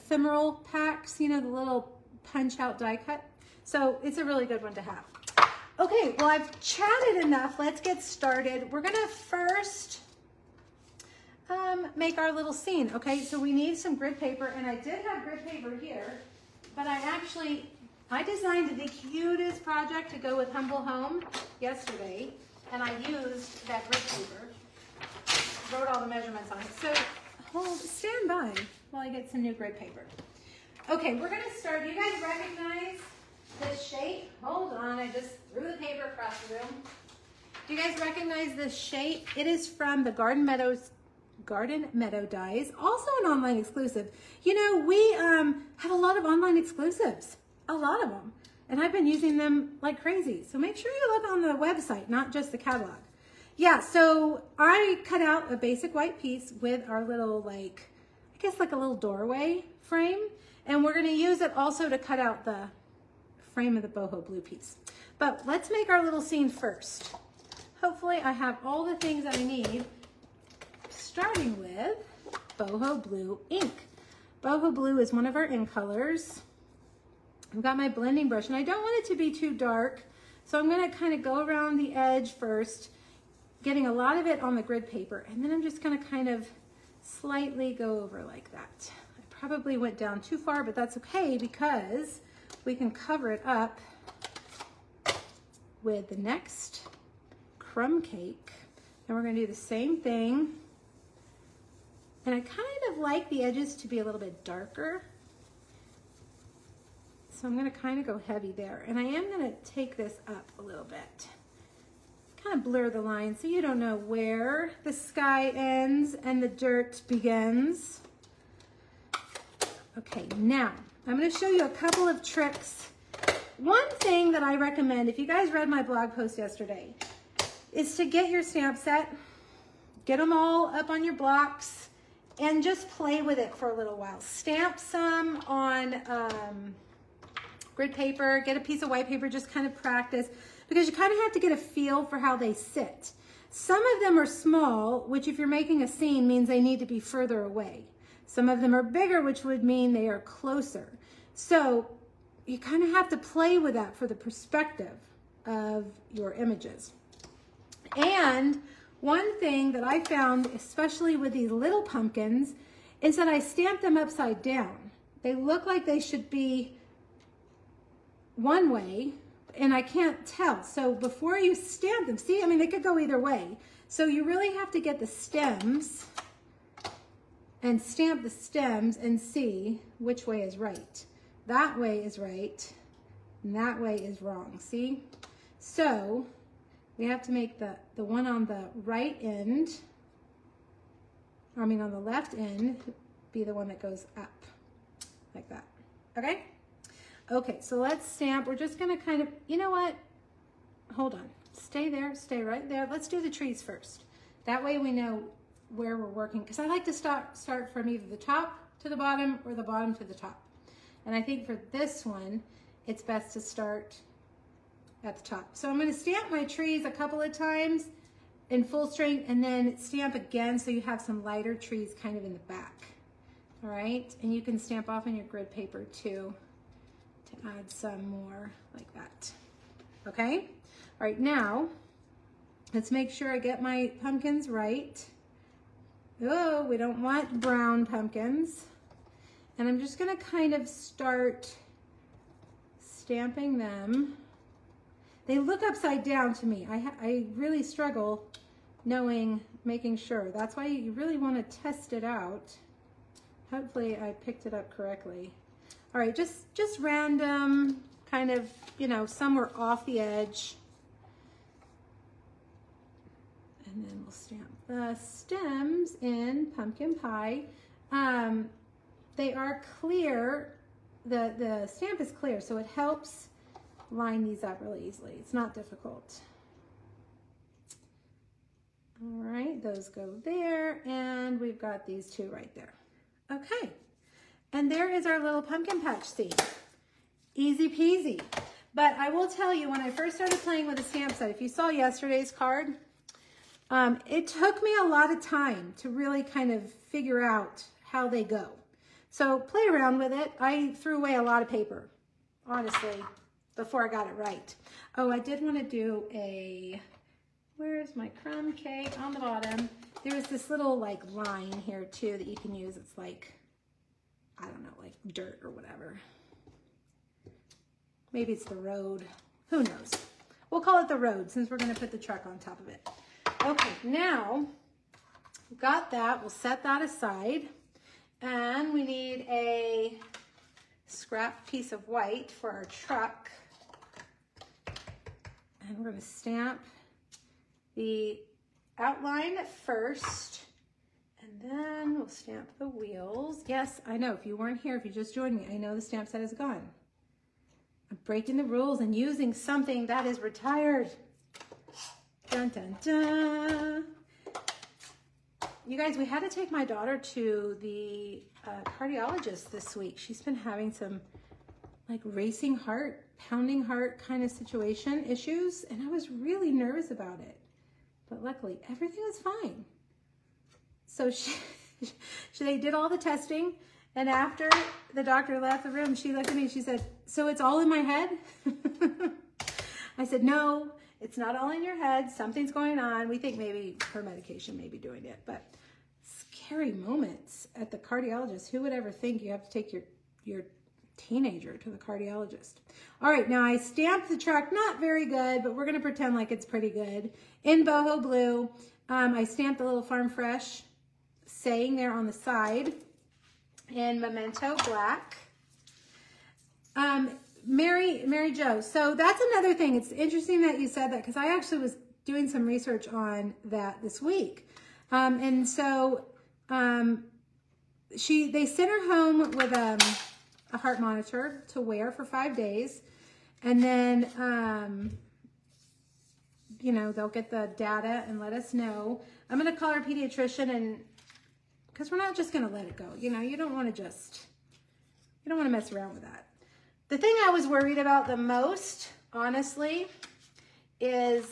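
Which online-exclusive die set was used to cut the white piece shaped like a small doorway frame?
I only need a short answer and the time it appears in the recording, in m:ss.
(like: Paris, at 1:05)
Garden Meadow Dies, at 0:41.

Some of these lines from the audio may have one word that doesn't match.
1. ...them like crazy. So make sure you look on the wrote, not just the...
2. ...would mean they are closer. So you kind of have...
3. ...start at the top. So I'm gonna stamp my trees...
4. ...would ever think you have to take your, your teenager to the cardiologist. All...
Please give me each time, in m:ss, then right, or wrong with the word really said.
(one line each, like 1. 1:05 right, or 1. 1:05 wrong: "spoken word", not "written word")
1. 0:49 wrong: "website", not "wrote"
2. 2:29 right
3. 3:33 right
4. 6:28 right.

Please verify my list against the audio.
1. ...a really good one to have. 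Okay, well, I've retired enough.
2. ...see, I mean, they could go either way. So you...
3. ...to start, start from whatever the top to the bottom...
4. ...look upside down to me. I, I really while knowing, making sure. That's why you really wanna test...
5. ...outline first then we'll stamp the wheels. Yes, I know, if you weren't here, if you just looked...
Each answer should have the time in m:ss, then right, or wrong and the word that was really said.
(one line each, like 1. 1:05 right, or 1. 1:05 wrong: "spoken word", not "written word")
1. 0:04 wrong: "chatted", not "retired"
2. 2:52 right
3. 3:26 wrong: "either", not "whatever"
4. 4:05 wrong: "struggle", not "while"
5. 5:38 wrong: "joined", not "looked".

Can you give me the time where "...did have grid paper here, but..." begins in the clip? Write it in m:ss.
0:14.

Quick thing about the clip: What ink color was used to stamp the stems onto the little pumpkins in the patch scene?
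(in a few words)
Pumpkin Pie.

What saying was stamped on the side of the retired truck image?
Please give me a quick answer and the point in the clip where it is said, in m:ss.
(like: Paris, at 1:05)
Farm Fresh, at 6:39.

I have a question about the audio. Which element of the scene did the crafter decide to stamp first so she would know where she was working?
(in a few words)
the trees.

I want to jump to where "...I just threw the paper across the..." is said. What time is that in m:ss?
0:34.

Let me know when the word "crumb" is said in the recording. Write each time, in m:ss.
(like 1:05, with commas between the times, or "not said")
1:37, 5:08.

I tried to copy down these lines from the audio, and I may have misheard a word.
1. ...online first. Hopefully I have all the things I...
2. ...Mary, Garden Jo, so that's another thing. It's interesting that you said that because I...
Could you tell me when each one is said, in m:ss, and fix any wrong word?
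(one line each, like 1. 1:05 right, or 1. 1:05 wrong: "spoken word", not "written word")
1. 1:06 wrong: "scene", not "online"
2. 6:47 wrong: "Mary", not "Garden".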